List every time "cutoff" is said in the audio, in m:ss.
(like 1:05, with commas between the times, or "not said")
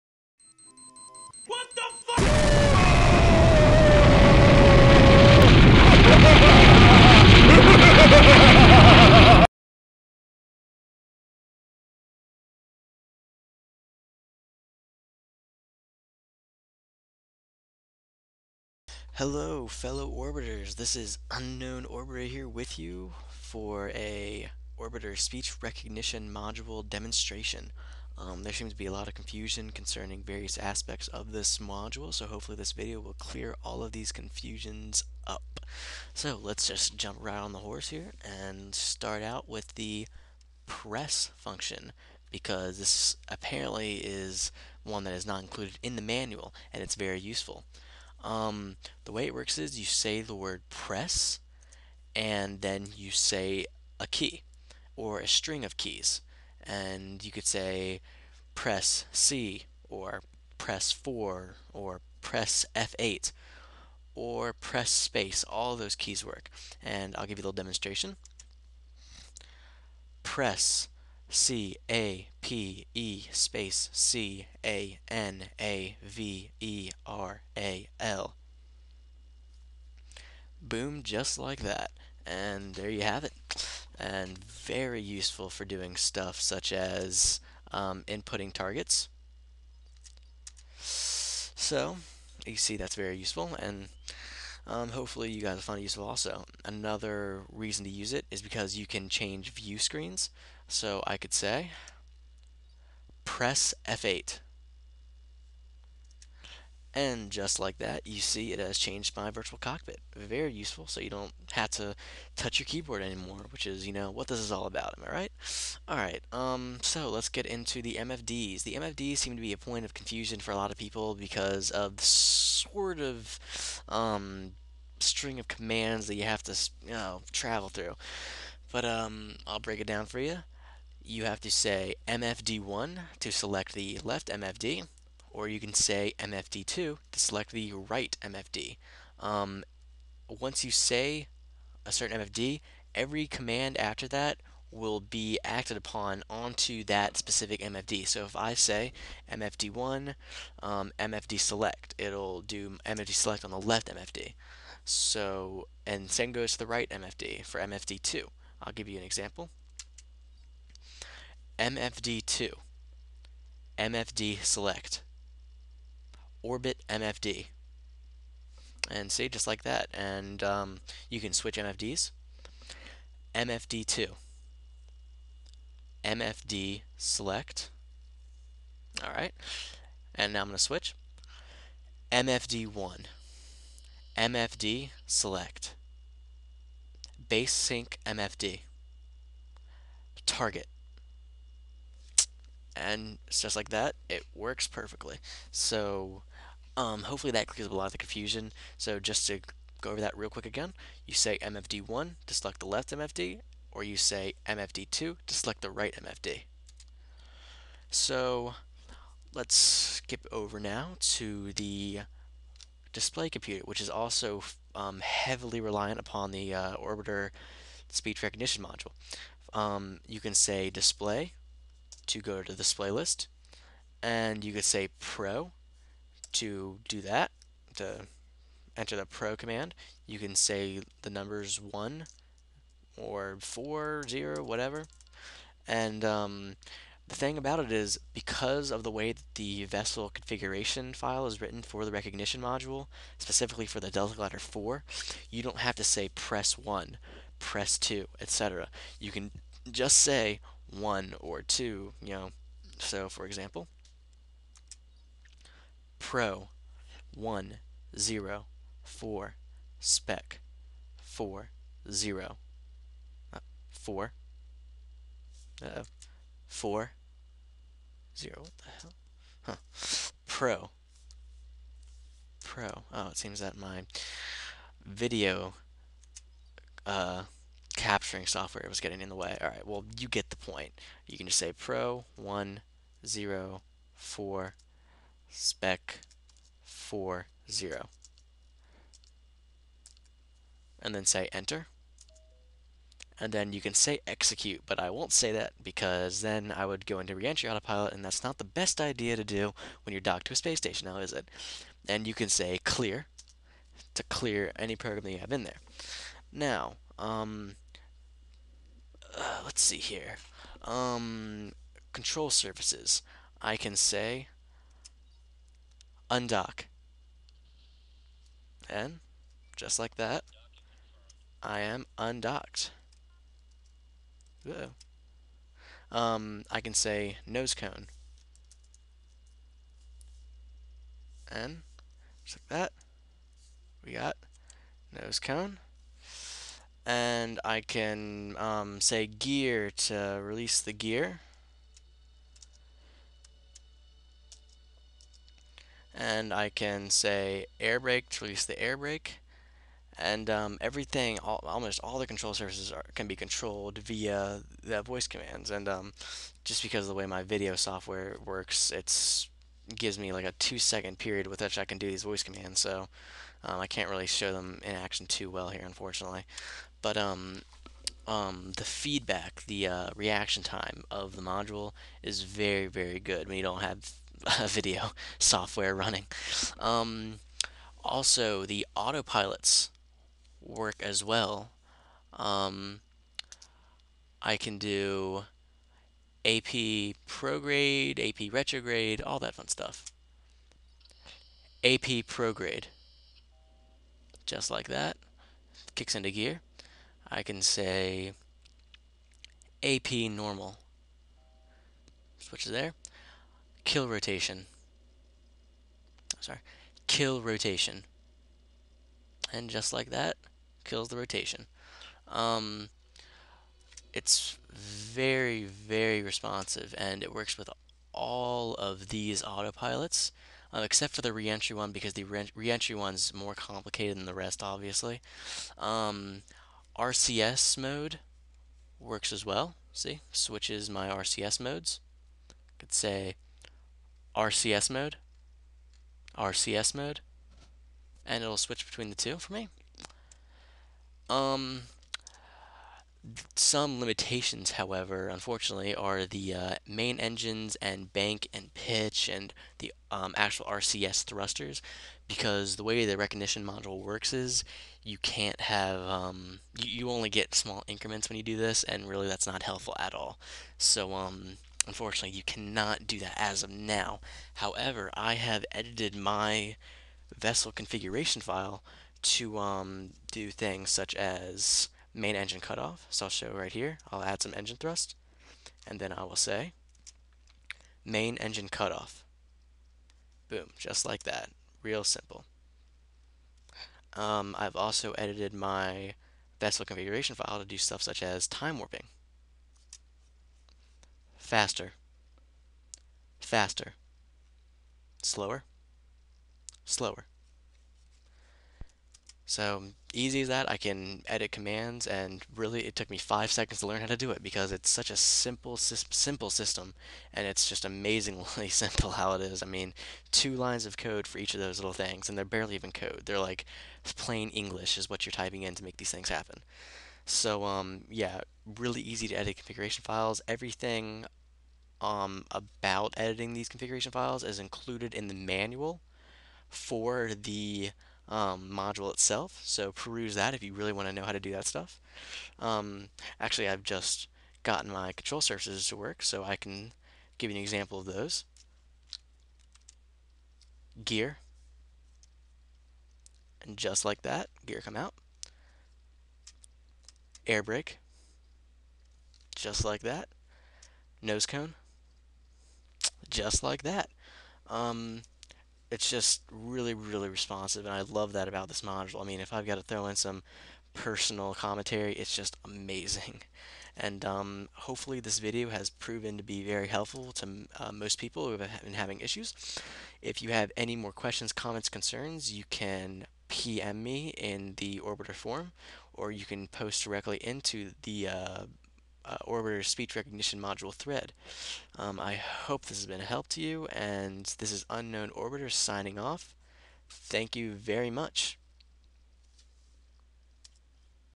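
7:52, 7:58.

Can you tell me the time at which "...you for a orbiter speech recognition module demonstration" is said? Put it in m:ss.
0:22.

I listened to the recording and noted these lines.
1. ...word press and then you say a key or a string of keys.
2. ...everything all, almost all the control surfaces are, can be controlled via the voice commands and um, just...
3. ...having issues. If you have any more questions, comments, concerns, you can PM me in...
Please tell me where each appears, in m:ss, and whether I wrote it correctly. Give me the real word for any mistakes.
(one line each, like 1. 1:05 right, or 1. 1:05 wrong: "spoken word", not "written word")
1. 0:50 right
2. 5:50 right
3. 9:28 right.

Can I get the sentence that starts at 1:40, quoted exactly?
So I could say press F8.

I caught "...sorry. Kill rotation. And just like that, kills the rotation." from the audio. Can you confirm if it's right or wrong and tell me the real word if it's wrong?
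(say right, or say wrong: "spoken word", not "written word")
right.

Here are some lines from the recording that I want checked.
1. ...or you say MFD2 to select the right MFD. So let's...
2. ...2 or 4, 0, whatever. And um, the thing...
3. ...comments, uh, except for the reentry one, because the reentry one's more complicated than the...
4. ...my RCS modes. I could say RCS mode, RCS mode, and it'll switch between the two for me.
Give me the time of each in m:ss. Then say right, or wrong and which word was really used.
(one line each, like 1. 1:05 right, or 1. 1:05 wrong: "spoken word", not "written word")
1. 3:23 right
2. 3:51 wrong: "1", not "2"
3. 6:59 wrong: "autopilots", not "comments"
4. 7:10 right.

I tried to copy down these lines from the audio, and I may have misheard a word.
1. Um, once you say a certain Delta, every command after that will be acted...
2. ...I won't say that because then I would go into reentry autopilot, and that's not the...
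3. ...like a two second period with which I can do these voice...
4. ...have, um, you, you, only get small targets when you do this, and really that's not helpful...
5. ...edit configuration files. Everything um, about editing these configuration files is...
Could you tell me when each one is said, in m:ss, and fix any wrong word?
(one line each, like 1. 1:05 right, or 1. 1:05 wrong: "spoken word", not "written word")
1. 2:19 wrong: "MFD", not "Delta"
2. 4:54 right
3. 6:00 right
4. 7:35 wrong: "increments", not "targets"
5. 8:39 right.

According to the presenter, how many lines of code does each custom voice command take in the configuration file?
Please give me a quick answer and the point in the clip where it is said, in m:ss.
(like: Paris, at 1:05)
2, at 8:30.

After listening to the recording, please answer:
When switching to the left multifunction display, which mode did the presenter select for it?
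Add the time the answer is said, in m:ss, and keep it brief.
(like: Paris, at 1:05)
base sync MFD, at 3:07.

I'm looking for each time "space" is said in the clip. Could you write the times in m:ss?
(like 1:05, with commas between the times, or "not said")
1:04, 1:13, 5:00.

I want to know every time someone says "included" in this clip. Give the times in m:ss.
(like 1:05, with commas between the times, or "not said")
0:45, 8:44.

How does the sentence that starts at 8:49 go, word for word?
So peruse that if you really want to know how to do that stuff.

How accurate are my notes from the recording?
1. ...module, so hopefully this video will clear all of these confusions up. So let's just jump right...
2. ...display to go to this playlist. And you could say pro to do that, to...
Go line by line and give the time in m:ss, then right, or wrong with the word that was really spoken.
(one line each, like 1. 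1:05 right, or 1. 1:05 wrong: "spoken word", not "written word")
1. 0:31 right
2. 3:40 right.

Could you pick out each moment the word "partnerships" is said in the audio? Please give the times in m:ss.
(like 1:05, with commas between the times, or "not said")
not said.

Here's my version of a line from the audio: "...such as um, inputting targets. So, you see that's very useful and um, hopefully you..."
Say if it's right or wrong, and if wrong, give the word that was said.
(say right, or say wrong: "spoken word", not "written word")
right.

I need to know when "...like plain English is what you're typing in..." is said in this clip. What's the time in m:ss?
8:33.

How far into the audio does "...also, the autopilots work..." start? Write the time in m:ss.
6:17.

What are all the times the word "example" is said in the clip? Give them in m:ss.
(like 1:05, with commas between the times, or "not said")
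2:39, 4:13, 8:57.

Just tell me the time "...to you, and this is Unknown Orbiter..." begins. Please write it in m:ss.
9:43.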